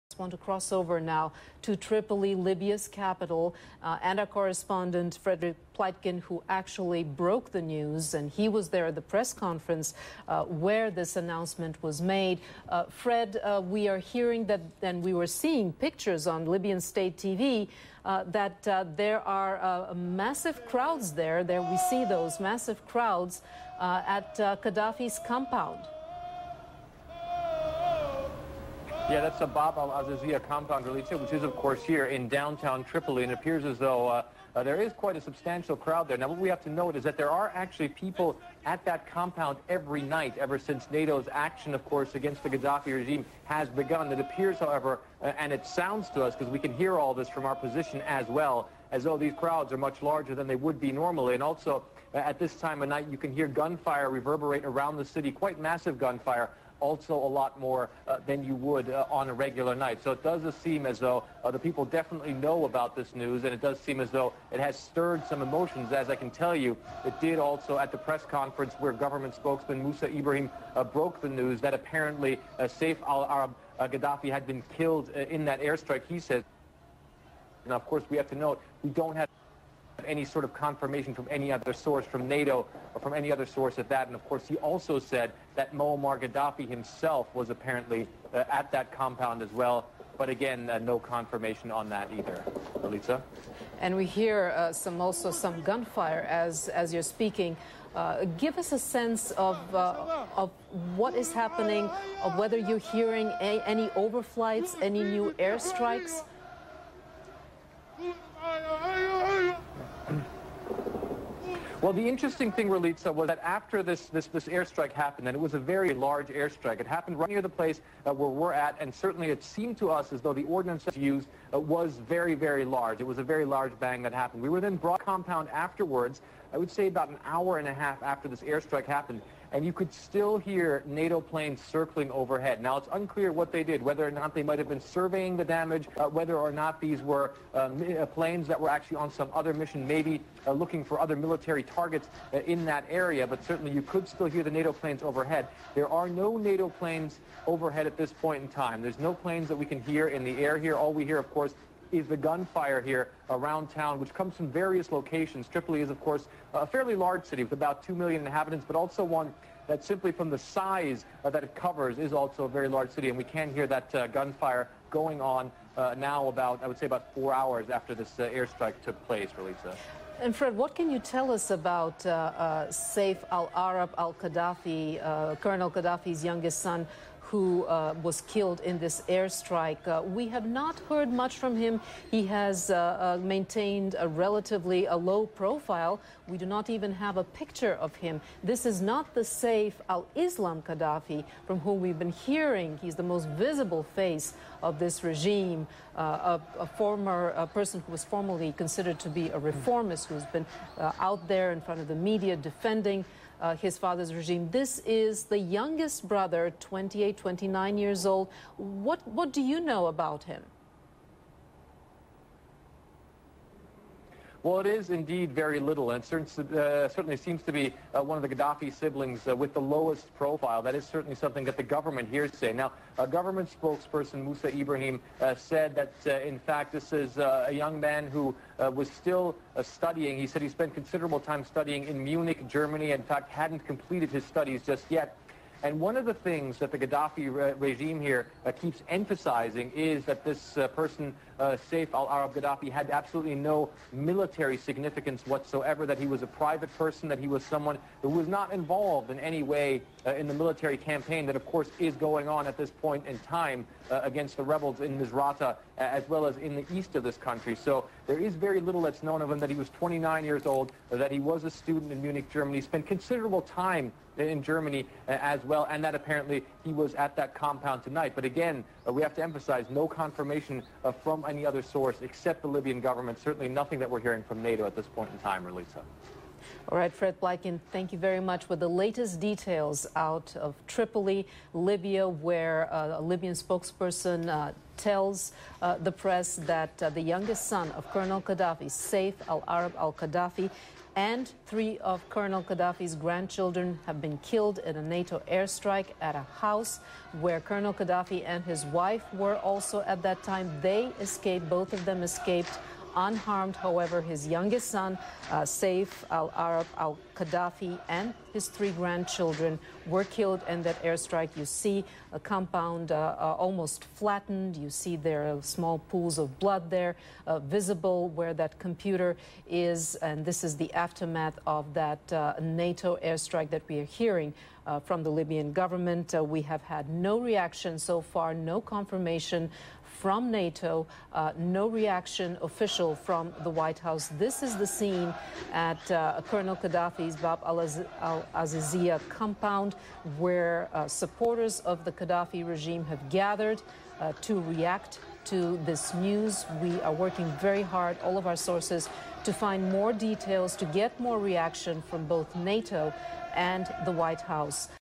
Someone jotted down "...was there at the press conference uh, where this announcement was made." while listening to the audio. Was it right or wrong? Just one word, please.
right.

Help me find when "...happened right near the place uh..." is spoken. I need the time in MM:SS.
01:56.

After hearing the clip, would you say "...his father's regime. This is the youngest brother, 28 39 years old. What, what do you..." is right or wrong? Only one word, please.
wrong.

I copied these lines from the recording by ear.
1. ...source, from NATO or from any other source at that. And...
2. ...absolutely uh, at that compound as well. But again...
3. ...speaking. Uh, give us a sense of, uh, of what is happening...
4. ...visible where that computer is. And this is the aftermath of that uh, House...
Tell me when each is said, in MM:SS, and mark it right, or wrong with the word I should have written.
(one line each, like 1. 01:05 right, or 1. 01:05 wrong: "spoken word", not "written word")
1. 01:21 right
2. 01:27 wrong: "apparently", not "absolutely"
3. 01:37 right
4. 05:17 wrong: "NATO", not "House".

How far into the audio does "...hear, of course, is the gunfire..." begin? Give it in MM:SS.
02:31.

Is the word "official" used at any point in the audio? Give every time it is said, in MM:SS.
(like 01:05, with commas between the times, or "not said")
05:32.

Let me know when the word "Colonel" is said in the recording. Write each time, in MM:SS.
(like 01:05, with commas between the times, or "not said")
02:55, 04:47, 04:52, 04:57, 05:36.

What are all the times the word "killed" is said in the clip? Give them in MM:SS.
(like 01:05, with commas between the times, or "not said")
01:14, 02:58, 04:54, 05:10.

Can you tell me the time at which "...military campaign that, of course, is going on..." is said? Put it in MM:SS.
04:10.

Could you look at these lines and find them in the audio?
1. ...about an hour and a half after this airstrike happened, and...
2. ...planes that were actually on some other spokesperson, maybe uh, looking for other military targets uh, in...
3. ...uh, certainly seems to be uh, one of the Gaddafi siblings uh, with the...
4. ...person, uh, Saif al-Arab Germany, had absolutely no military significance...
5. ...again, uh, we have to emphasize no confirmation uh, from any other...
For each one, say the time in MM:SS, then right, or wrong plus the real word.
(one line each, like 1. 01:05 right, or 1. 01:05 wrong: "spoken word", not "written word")
1. 02:06 right
2. 02:18 wrong: "mission", not "spokesperson"
3. 03:36 right
4. 04:00 wrong: "Gaddafi", not "Germany"
5. 04:28 right.